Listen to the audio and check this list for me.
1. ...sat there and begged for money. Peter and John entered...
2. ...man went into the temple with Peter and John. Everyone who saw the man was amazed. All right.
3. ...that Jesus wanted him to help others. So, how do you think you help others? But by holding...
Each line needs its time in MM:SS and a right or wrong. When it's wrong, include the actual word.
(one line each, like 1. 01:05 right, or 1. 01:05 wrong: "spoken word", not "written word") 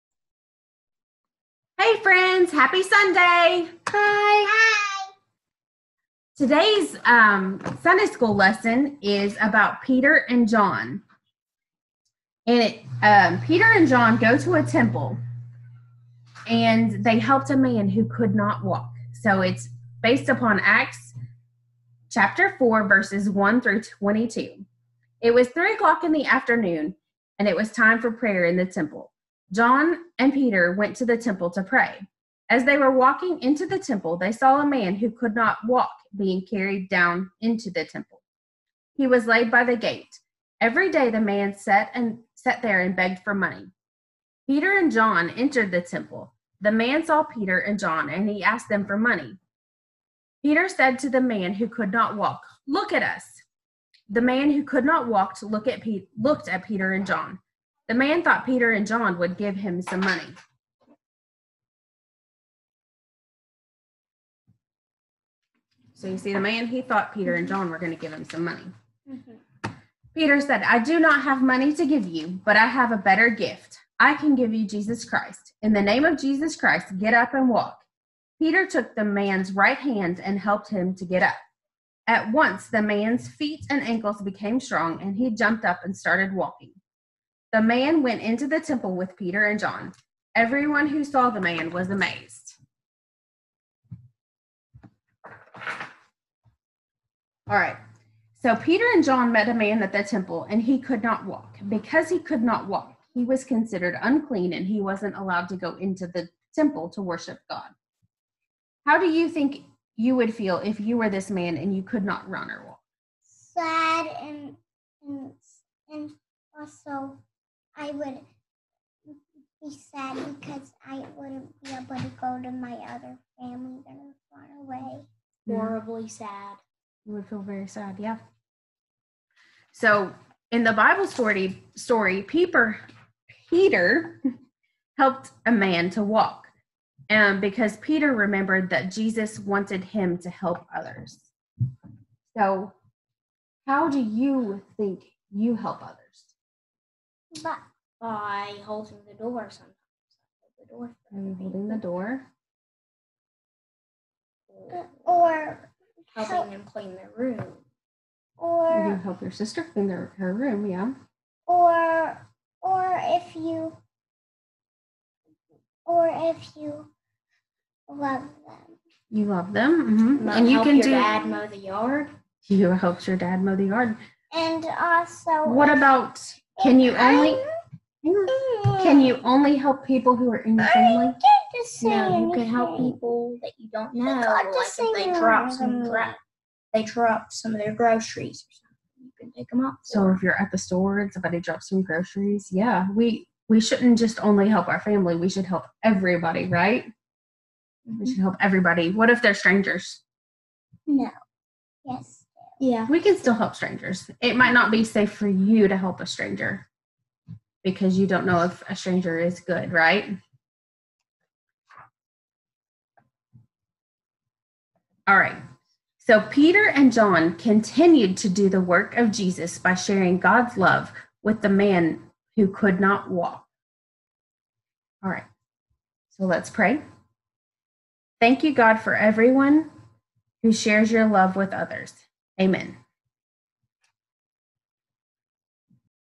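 1. 00:42 right
2. 01:27 right
3. 02:18 right.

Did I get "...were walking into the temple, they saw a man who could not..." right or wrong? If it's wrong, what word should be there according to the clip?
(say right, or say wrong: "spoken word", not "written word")
right.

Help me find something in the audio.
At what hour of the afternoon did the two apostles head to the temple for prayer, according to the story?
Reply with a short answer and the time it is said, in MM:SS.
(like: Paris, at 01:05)
3 o'clock, at 00:25.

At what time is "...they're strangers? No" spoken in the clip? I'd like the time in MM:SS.
03:19.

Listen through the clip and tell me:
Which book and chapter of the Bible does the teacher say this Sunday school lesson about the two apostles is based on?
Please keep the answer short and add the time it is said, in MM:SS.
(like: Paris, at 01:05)
Acts chapter 4, at 00:20.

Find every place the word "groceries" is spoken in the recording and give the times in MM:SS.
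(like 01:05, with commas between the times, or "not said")
03:07, 03:11.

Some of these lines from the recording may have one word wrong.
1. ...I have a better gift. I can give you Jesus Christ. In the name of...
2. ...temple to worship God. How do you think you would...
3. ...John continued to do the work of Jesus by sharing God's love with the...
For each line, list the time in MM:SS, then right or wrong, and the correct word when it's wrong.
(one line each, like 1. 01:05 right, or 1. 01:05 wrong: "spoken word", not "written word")
1. 01:12 right
2. 01:46 right
3. 03:36 right.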